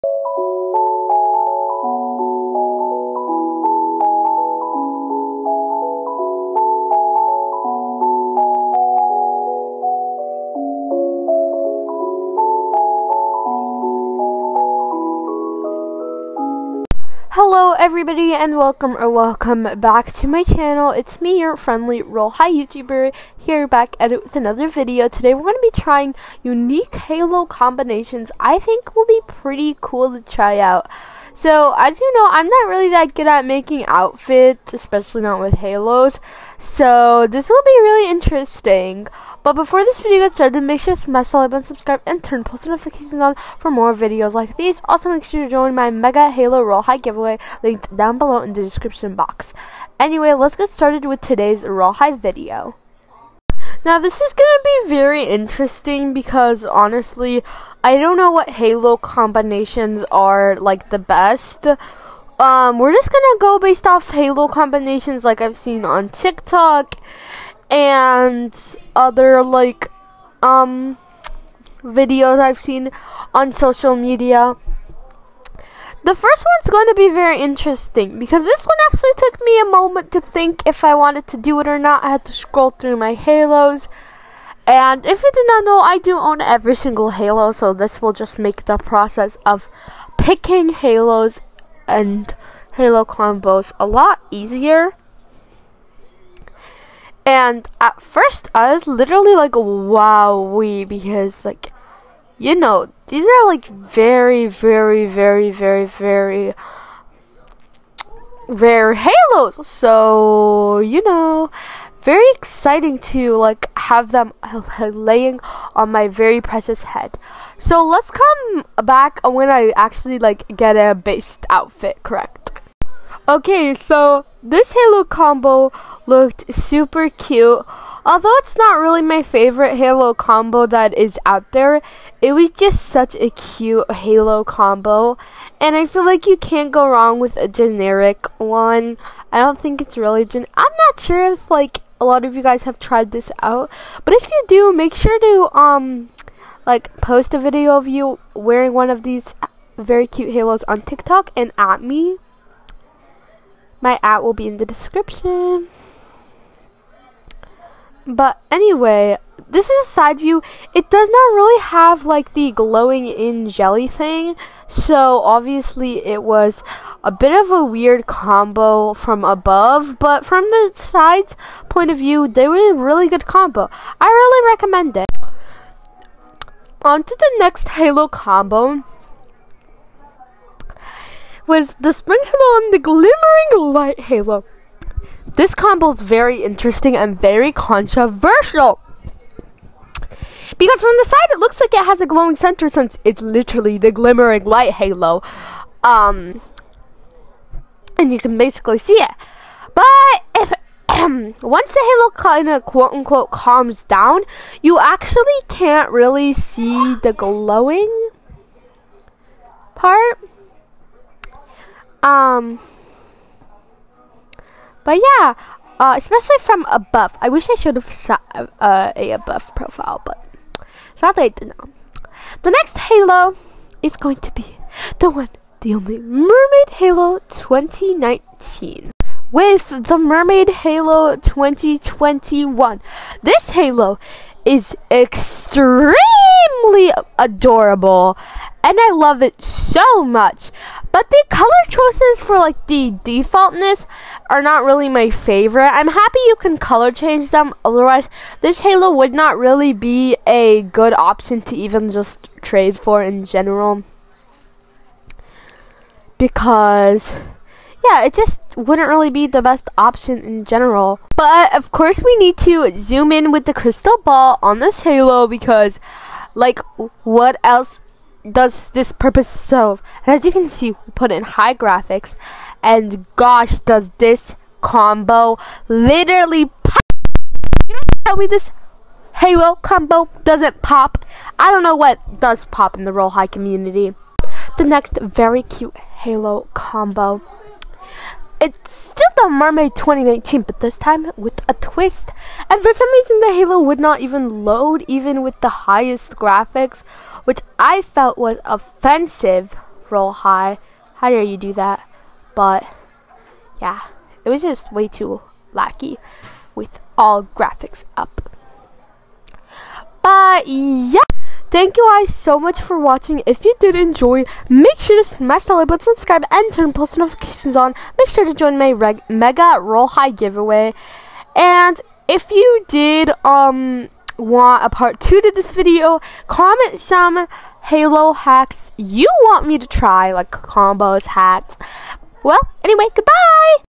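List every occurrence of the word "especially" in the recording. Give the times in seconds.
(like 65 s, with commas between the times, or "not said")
34 s, 215 s.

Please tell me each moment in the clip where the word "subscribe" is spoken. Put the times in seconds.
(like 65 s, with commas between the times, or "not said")
41 s, 315 s.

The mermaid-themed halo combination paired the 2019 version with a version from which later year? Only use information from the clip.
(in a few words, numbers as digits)
2021.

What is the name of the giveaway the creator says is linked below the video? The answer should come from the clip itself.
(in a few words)
Mega Halo Royale High giveaway.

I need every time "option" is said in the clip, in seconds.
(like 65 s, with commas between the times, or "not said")
250 s, 259 s.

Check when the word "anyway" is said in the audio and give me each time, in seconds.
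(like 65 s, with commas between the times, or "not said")
49 s, 158 s, 332 s.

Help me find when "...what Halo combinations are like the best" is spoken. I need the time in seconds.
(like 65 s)
58 s.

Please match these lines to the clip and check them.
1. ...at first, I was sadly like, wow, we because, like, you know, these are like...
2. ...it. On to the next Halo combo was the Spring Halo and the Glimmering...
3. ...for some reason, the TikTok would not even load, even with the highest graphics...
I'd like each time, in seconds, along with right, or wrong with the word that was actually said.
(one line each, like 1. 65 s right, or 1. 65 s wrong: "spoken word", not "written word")
1. 97 s wrong: "literally", not "sadly"
2. 174 s right
3. 292 s wrong: "Halo", not "TikTok".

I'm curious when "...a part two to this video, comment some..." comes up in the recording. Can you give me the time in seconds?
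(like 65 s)
324 s.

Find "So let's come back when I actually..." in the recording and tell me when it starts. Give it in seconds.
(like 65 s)
117 s.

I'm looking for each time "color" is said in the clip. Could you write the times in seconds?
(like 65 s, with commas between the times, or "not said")
241 s, 246 s.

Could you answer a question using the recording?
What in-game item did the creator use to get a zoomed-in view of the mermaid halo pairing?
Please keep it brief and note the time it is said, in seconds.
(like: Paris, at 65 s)
crystal ball, at 263 s.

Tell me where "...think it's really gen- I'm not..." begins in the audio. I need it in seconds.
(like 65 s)
139 s.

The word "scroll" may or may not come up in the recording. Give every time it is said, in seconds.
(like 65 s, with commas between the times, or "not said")
82 s.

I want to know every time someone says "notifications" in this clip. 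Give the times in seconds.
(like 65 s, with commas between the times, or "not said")
42 s, 316 s.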